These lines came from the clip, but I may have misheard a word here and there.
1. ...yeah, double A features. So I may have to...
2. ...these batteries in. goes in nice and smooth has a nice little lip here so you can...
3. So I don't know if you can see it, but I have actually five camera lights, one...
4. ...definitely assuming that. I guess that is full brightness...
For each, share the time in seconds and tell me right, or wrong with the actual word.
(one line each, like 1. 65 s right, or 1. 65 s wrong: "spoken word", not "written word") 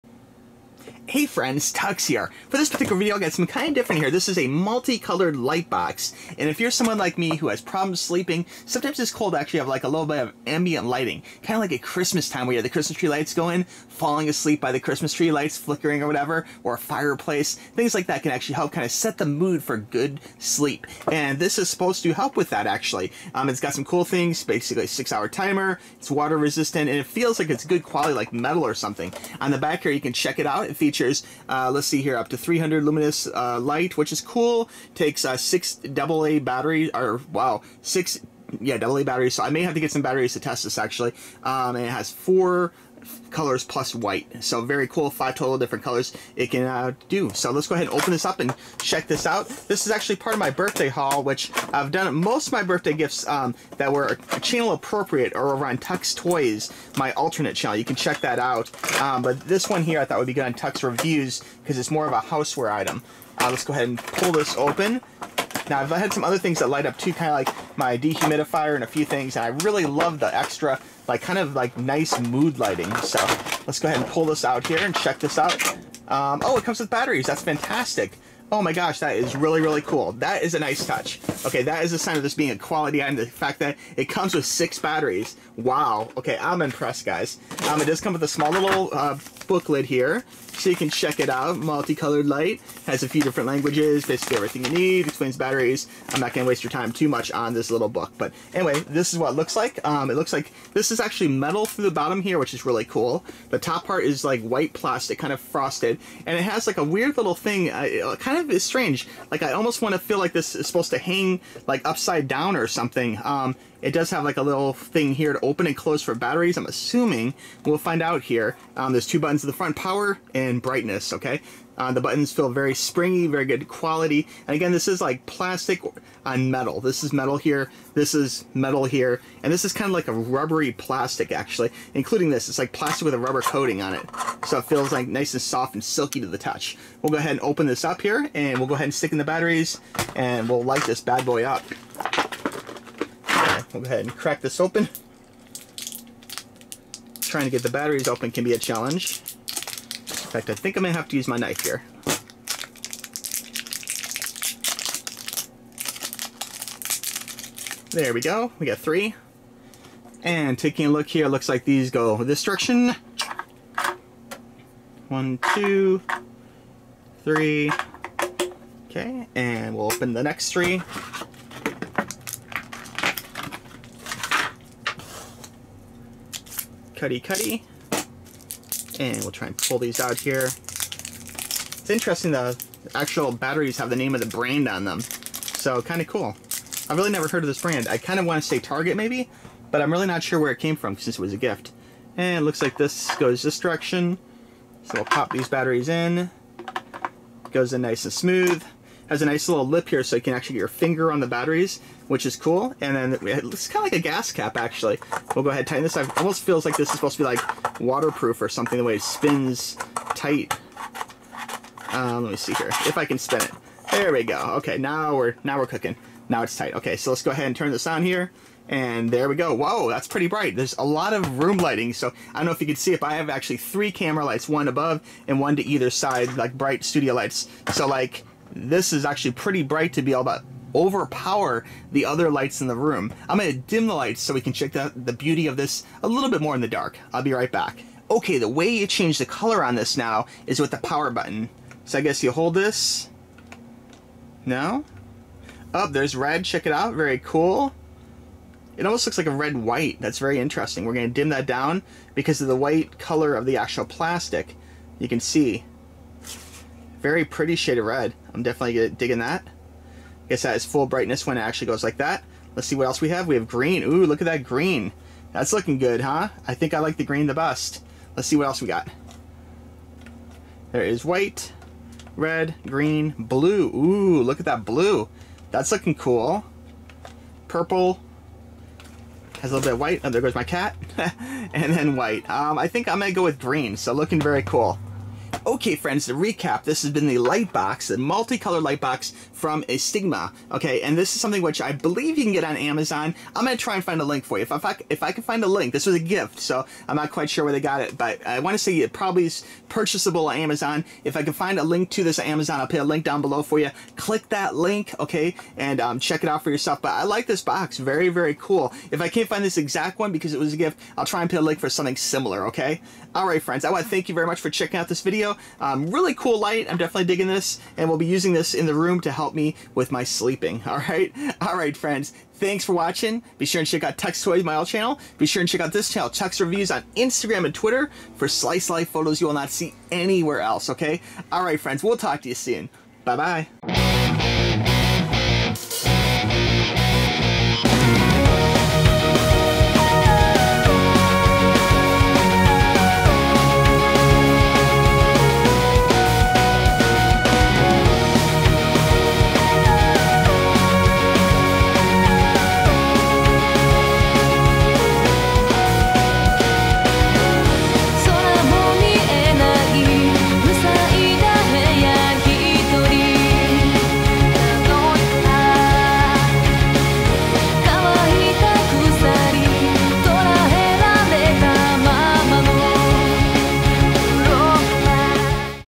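1. 38 s wrong: "batteries", not "features"
2. 195 s right
3. 221 s wrong: "three", not "five"
4. 258 s wrong: "digging", not "assuming".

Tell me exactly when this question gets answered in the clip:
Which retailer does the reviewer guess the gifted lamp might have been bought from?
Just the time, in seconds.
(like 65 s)
188 s.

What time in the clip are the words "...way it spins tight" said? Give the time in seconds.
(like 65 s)
208 s.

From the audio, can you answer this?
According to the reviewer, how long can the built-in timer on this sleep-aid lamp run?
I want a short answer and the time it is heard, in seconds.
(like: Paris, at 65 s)
6 hours, at 24 s.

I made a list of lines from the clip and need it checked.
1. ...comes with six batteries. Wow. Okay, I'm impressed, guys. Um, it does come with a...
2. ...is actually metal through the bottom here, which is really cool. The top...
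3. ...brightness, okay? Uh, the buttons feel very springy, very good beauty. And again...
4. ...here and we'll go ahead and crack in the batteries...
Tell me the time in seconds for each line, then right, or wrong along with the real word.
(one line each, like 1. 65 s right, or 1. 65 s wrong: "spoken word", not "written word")
1. 84 s right
2. 100 s right
3. 120 s wrong: "quality", not "beauty"
4. 138 s wrong: "stick", not "crack".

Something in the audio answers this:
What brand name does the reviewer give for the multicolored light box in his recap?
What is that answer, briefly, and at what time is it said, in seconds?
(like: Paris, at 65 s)
Stigma, at 289 s.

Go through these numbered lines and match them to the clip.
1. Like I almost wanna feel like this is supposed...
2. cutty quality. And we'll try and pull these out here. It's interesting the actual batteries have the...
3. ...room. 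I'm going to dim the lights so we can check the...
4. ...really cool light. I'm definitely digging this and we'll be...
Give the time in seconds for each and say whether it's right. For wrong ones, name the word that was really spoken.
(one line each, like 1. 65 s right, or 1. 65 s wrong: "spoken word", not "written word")
1. 109 s right
2. 177 s wrong: "cutty", not "quality"
3. 232 s right
4. 315 s right.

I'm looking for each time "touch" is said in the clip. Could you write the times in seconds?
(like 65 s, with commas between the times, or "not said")
80 s, 136 s.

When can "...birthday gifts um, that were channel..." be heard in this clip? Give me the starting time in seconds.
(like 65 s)
52 s.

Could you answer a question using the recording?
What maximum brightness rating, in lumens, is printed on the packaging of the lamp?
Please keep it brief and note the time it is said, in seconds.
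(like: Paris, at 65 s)
300, at 32 s.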